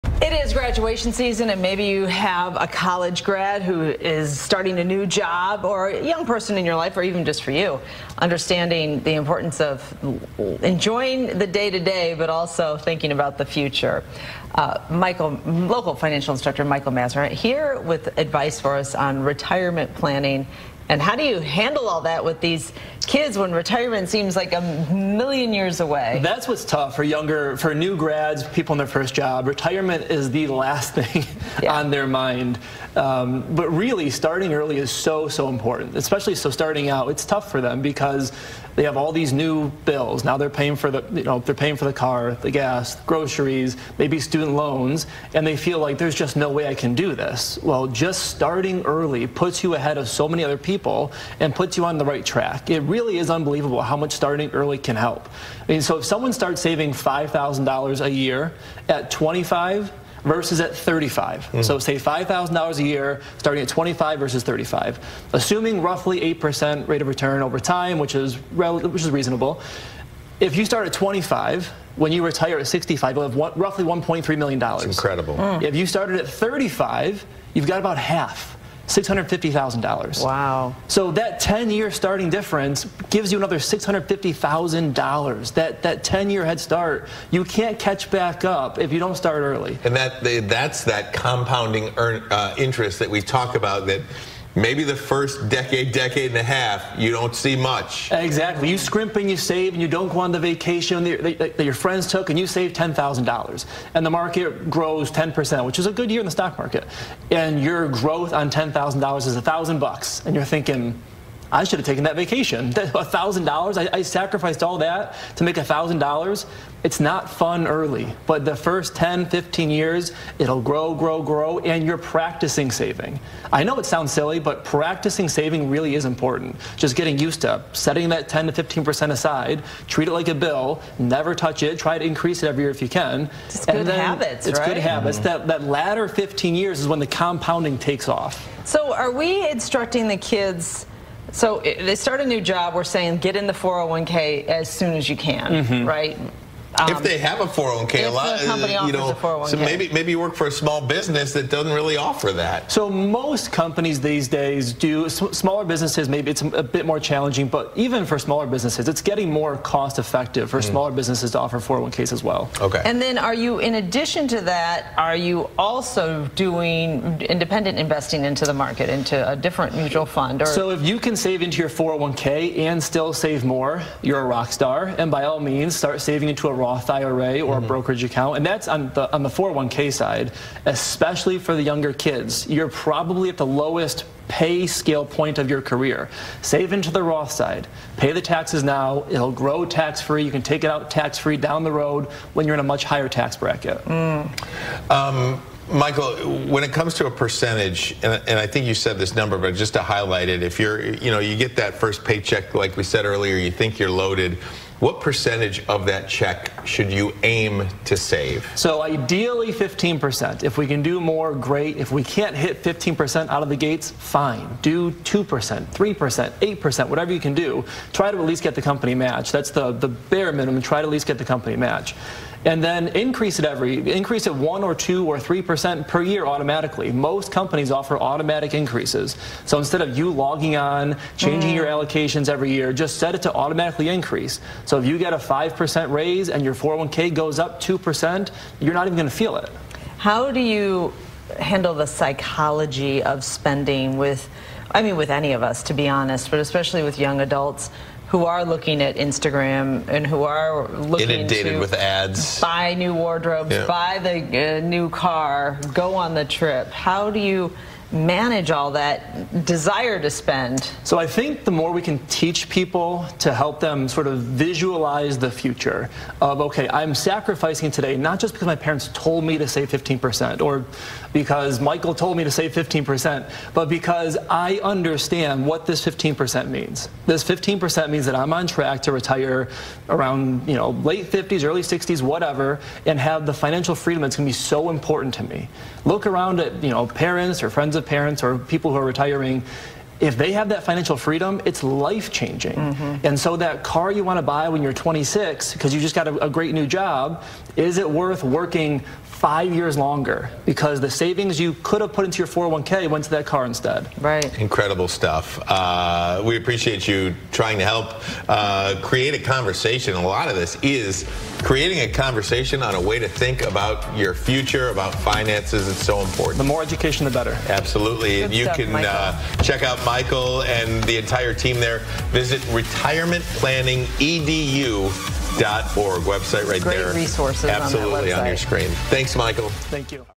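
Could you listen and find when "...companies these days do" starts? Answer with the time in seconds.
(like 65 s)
153 s.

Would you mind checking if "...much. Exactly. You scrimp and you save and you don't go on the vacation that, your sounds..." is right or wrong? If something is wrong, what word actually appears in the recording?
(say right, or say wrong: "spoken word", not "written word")
wrong: "friends", not "sounds".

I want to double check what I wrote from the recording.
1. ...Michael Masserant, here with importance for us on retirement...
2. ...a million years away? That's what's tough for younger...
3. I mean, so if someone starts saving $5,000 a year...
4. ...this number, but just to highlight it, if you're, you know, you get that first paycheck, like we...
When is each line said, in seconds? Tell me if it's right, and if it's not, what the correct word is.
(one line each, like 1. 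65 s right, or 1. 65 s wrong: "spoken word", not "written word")
1. 16 s wrong: "advice", not "importance"
2. 24 s right
3. 55 s right
4. 198 s right.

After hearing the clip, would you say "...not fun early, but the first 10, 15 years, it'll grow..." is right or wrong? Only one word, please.
right.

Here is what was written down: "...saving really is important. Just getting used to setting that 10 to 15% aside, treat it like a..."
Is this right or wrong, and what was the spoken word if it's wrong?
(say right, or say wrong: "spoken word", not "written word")
right.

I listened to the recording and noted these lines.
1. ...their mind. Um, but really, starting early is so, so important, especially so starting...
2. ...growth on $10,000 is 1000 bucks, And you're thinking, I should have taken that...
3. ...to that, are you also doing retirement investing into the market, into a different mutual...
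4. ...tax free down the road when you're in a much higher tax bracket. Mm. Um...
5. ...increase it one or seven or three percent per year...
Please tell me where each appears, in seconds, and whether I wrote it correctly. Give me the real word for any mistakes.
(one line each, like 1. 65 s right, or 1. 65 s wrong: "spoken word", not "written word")
1. 31 s right
2. 107 s right
3. 164 s wrong: "independent", not "retirement"
4. 190 s right
5. 223 s wrong: "two", not "seven".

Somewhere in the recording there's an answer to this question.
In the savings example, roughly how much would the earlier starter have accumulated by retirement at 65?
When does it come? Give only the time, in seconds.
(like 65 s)
73 s.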